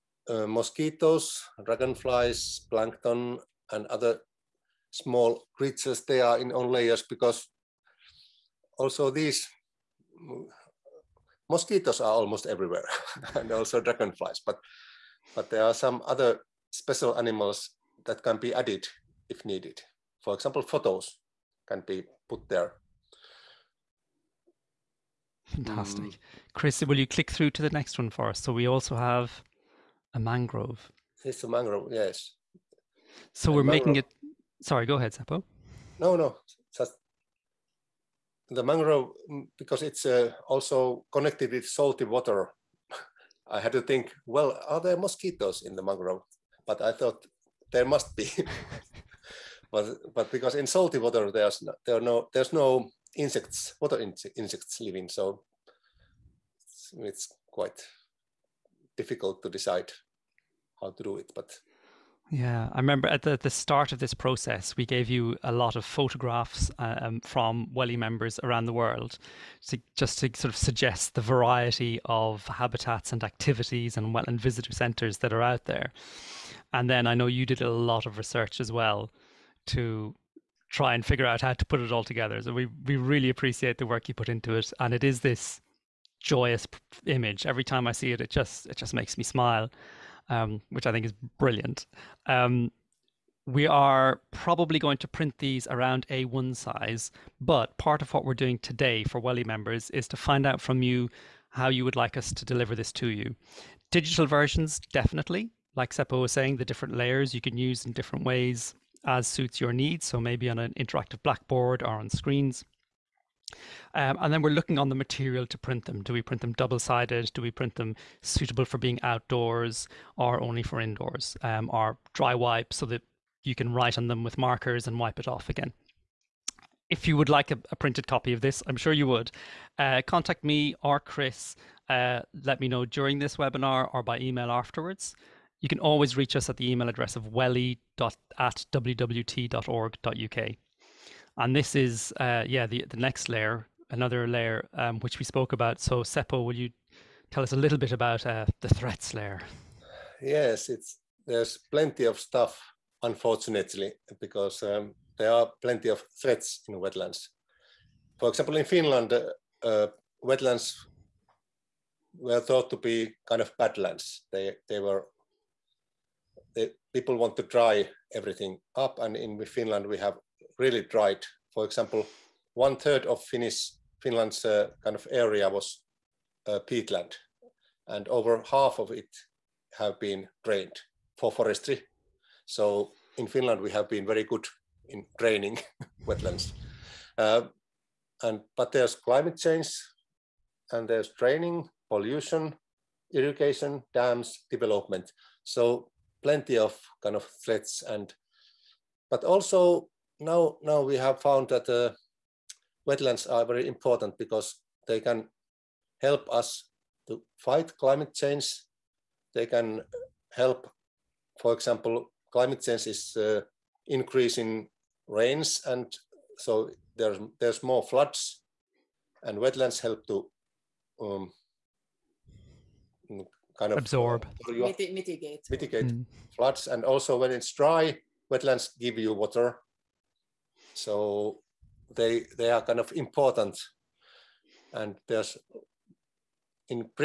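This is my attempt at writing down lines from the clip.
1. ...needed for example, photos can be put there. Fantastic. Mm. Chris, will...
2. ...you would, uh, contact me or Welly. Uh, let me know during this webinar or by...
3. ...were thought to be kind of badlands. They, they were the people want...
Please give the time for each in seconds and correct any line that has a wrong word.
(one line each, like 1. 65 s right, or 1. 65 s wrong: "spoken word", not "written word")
1. 19 s right
2. 128 s wrong: "Chris", not "Welly"
3. 162 s right.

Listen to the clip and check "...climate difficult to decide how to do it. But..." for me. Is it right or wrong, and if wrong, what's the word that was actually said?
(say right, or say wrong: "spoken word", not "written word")
wrong: "quite", not "climate".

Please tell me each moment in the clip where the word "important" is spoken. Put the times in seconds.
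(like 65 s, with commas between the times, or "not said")
203 s, 232 s.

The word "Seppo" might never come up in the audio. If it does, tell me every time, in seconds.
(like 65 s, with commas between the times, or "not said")
35 s, 105 s, 146 s.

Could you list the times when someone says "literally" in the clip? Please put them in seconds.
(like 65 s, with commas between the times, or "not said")
not said.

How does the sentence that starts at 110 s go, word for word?
So maybe on an interactive blackboard or on screens.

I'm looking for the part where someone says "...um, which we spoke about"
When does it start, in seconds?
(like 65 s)
144 s.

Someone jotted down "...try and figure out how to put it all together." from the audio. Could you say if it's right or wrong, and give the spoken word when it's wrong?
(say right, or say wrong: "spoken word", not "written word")
right.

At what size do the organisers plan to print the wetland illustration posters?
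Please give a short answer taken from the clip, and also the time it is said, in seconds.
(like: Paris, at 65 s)
A1, at 96 s.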